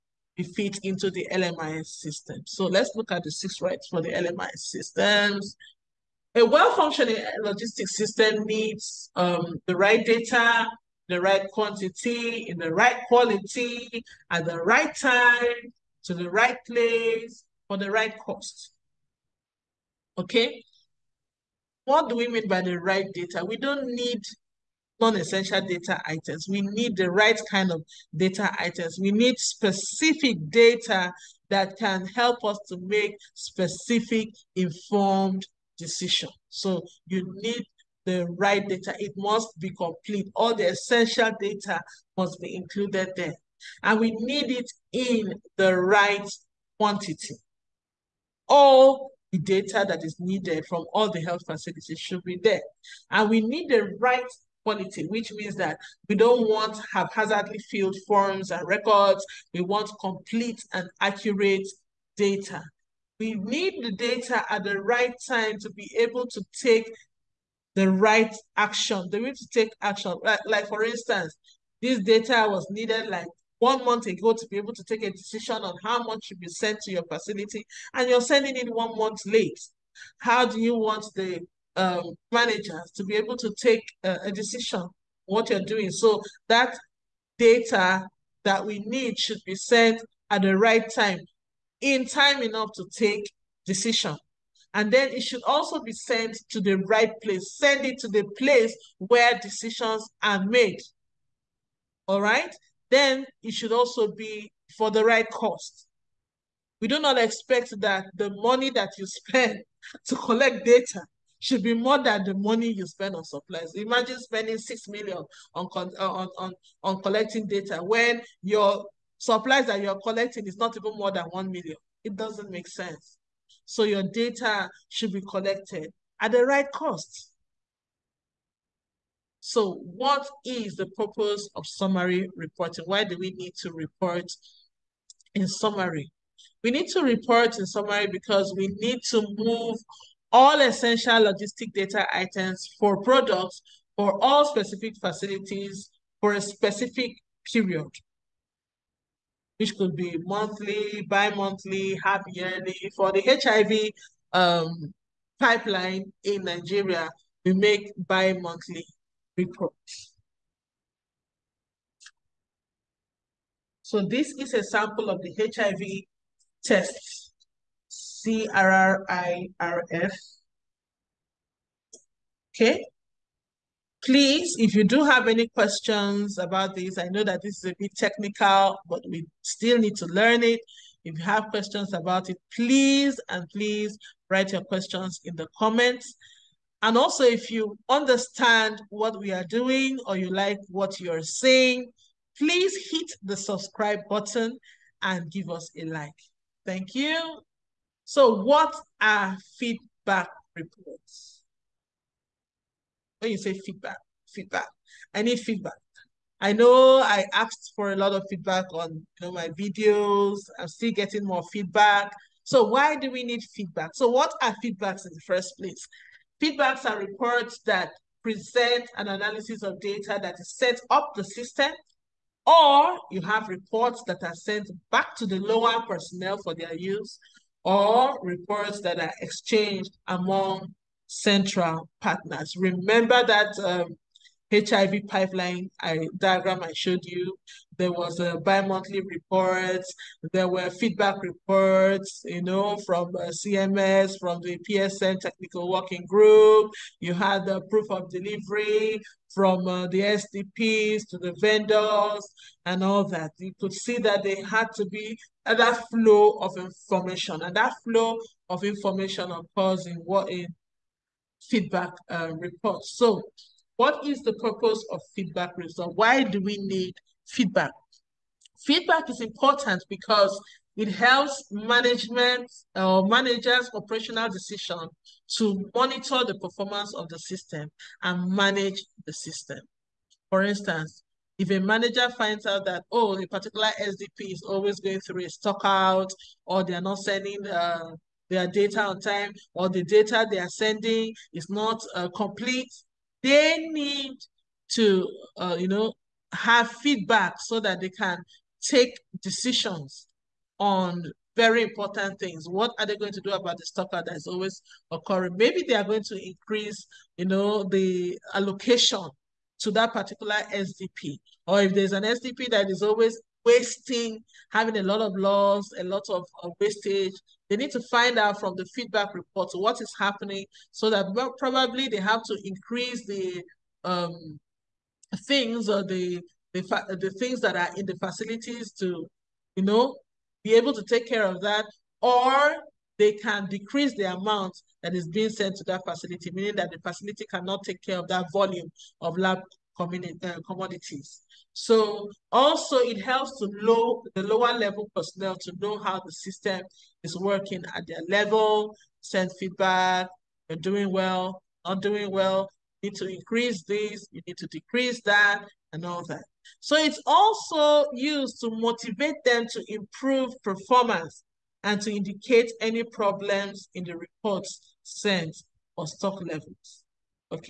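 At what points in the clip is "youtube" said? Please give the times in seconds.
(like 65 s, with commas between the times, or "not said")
not said.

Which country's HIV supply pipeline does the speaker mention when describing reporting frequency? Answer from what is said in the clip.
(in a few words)
Nigeria.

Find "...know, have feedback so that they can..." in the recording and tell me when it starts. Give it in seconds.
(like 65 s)
295 s.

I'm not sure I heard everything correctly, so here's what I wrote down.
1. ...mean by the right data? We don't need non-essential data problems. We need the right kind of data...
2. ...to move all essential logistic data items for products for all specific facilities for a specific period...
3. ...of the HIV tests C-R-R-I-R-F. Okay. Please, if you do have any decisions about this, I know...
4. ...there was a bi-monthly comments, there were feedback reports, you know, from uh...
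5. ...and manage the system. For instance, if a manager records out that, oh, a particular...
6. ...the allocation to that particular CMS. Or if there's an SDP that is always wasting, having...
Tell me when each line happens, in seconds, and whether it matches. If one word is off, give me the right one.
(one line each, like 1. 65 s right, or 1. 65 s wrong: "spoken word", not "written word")
1. 22 s wrong: "items", not "problems"
2. 139 s right
3. 165 s wrong: "questions", not "decisions"
4. 237 s wrong: "reports", not "comments"
5. 278 s wrong: "finds", not "records"
6. 307 s wrong: "SDP", not "CMS".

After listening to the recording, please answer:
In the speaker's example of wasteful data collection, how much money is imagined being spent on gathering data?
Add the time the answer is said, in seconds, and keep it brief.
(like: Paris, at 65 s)
6 million, at 114 s.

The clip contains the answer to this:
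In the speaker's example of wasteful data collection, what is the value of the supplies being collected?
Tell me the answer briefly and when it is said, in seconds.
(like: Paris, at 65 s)
1 million, at 121 s.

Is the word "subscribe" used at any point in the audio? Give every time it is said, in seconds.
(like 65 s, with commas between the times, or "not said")
193 s.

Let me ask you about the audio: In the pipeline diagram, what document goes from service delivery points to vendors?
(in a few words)
Proof of delivery.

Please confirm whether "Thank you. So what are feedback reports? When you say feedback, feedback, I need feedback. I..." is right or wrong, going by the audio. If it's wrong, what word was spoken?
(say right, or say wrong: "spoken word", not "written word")
right.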